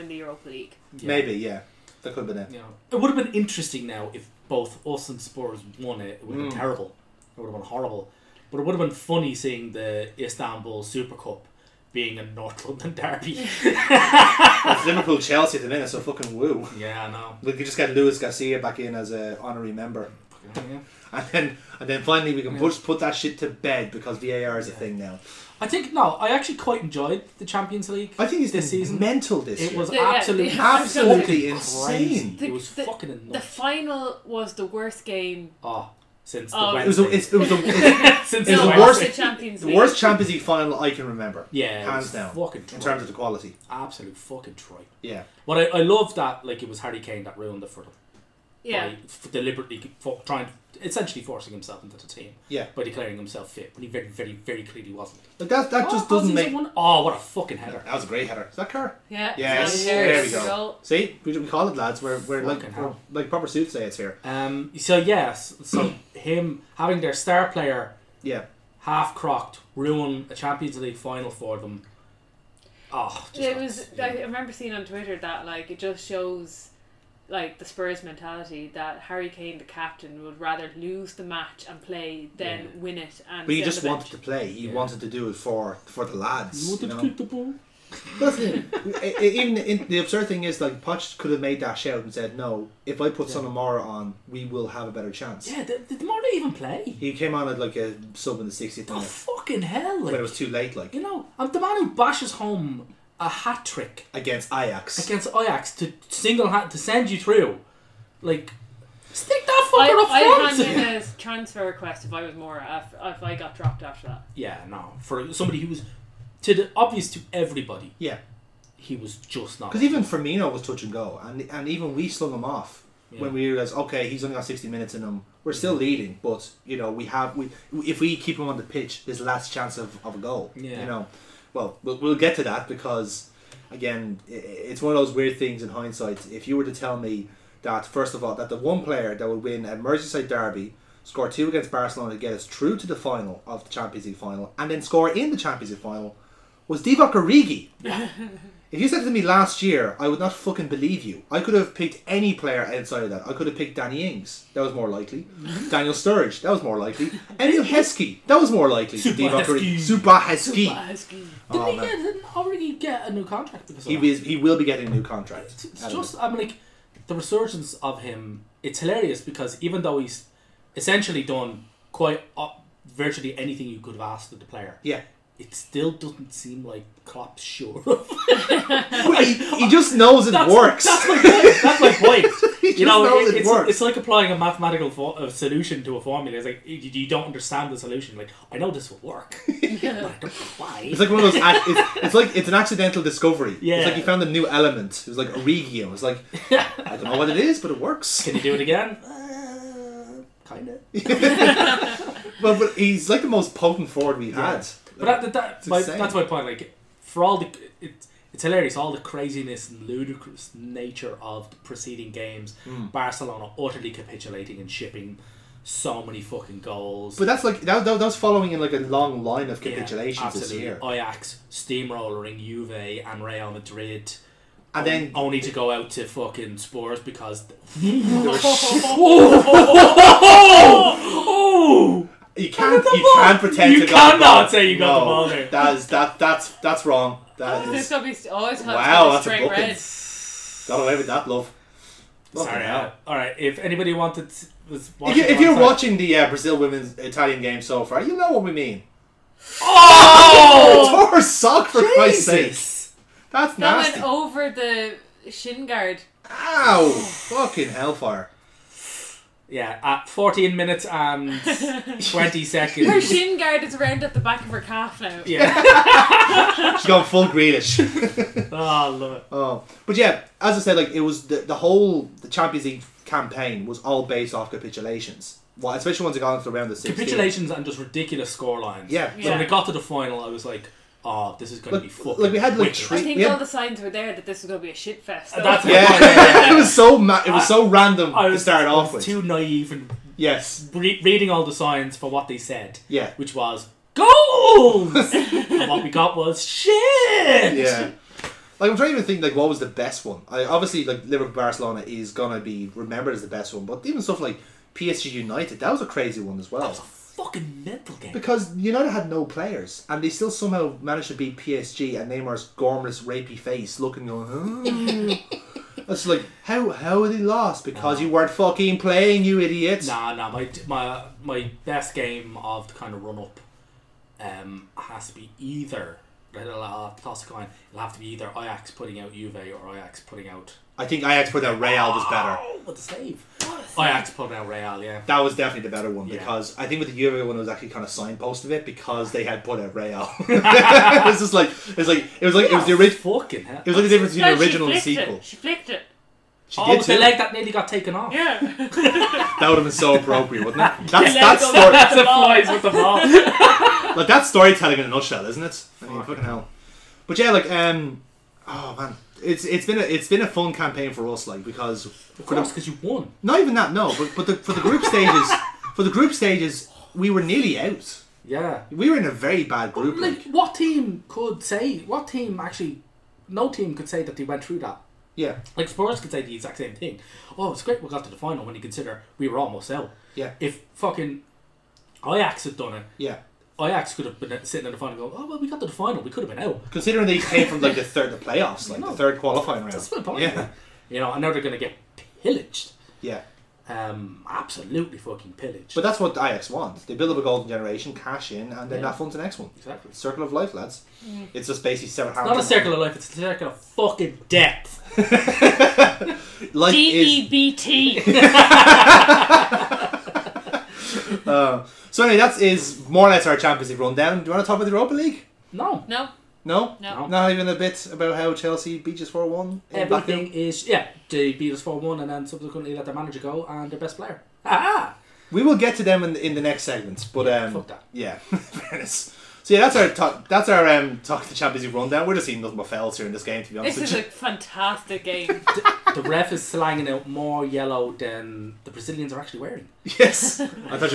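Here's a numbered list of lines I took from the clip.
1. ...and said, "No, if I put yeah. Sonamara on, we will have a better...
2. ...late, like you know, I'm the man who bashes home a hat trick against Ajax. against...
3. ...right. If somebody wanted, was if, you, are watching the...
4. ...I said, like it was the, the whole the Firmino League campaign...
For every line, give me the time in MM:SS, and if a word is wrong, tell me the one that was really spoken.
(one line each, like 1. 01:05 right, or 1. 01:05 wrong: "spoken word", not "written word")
1. 01:32 right
2. 01:40 right
3. 04:03 wrong: "anybody", not "somebody"
4. 04:30 wrong: "Champions", not "Firmino".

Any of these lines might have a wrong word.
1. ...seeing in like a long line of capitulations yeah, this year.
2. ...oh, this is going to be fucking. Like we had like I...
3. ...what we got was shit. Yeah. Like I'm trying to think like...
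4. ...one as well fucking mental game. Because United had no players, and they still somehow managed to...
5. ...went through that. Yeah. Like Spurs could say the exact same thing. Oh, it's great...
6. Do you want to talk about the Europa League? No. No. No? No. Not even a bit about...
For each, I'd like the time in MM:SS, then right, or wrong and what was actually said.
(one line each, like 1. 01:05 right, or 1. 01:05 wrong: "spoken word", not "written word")
1. 03:38 wrong: "following", not "seeing"
2. 04:41 right
3. 04:55 right
4. 05:06 right
5. 06:14 right
6. 06:54 right.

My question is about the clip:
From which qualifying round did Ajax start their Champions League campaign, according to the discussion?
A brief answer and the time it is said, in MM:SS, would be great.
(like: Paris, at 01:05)
third qualifying round, at 06:28.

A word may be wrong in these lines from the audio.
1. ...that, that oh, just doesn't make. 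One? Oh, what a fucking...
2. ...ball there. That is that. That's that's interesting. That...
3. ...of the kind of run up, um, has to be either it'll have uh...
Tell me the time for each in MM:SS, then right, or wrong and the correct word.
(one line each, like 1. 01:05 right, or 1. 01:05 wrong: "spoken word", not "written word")
1. 00:55 right
2. 03:55 wrong: "wrong", not "interesting"
3. 05:22 right.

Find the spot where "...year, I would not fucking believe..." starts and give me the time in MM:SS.
02:29.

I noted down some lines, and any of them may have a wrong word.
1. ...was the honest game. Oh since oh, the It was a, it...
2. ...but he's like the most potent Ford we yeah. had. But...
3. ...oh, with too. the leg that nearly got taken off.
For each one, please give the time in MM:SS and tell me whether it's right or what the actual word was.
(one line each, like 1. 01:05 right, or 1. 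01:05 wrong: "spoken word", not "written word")
1. 00:34 wrong: "worst", not "honest"
2. 03:22 right
3. 05:46 right.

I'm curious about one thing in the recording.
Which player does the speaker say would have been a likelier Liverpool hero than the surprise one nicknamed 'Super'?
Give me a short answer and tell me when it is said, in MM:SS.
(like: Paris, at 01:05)
Emile Heskey, at 02:37.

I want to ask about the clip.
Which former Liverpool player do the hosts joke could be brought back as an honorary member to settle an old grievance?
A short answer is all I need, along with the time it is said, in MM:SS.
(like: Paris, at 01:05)
Luis Garcia, at 00:17.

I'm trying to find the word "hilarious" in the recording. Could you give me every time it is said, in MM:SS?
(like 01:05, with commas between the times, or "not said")
02:48, 03:28.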